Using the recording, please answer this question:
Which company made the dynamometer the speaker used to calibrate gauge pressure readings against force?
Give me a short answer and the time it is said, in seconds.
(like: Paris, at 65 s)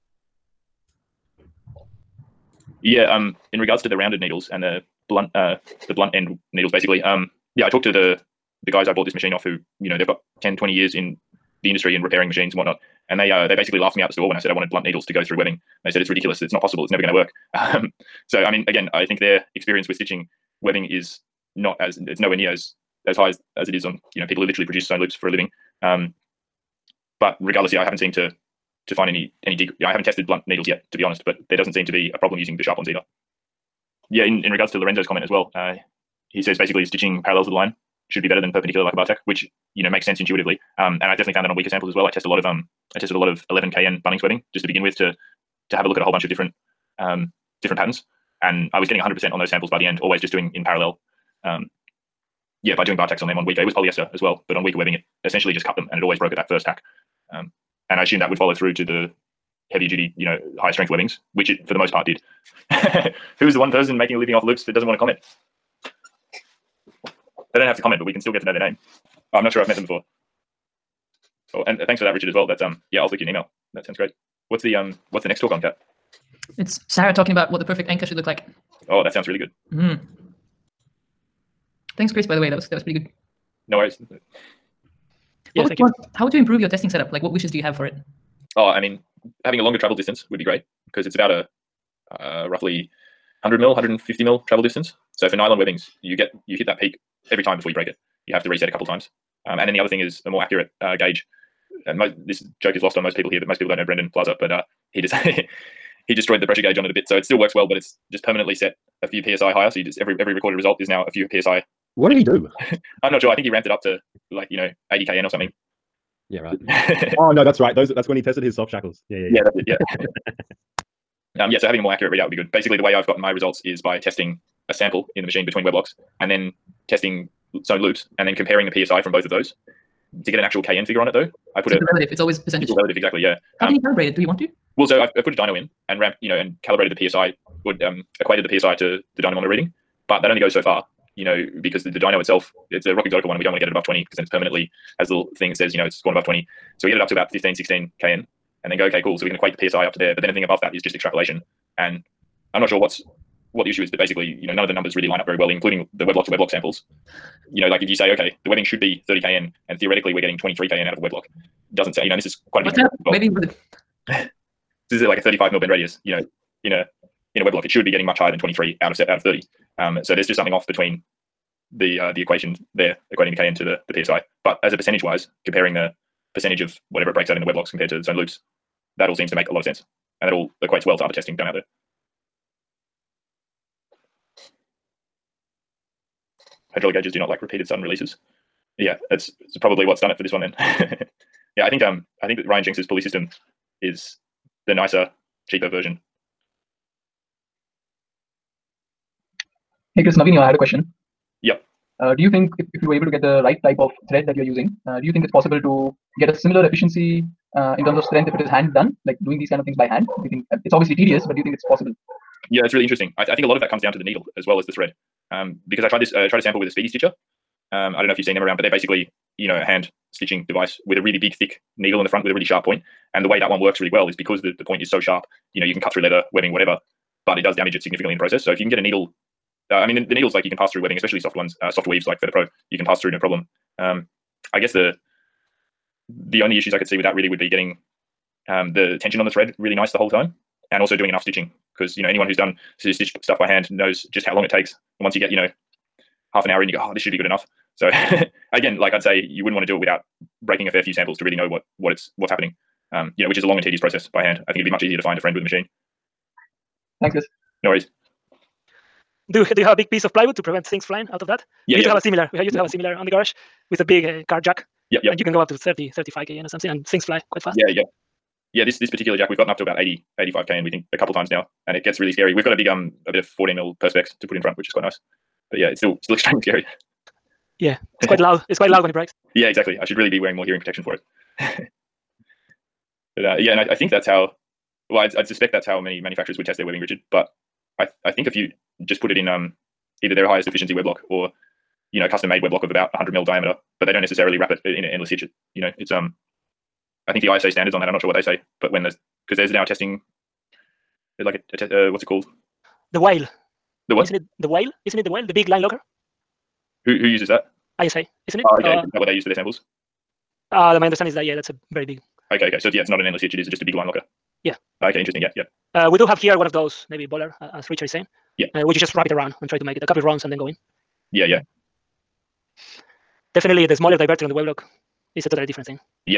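Rock Exotica, at 142 s.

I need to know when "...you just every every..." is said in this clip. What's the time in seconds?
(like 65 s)
109 s.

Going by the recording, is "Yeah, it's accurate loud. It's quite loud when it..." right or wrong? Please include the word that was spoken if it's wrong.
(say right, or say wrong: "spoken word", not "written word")
wrong: "quite", not "accurate".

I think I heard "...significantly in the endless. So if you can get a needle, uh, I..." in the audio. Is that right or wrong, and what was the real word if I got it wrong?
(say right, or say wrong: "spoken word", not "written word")
wrong: "process", not "endless".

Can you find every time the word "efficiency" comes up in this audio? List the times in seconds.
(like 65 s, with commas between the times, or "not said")
206 s, 290 s.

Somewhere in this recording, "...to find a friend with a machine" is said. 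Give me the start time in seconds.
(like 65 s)
254 s.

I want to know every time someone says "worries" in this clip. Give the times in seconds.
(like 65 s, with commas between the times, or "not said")
83 s, 257 s.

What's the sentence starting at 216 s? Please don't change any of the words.
Uh, I tried a sample with a speedy stitcher.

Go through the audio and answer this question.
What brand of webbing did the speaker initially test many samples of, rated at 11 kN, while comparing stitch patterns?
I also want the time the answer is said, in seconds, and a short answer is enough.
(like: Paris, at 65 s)
Bunnings, at 44 s.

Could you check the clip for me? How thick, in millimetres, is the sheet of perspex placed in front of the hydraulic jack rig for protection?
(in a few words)
14 mm.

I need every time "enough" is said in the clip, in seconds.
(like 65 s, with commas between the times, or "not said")
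241 s, 247 s.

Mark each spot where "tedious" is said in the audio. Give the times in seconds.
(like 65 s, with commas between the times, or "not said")
210 s, 253 s.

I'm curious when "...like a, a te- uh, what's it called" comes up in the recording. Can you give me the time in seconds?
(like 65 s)
301 s.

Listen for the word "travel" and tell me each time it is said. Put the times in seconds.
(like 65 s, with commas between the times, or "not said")
89 s, 94 s.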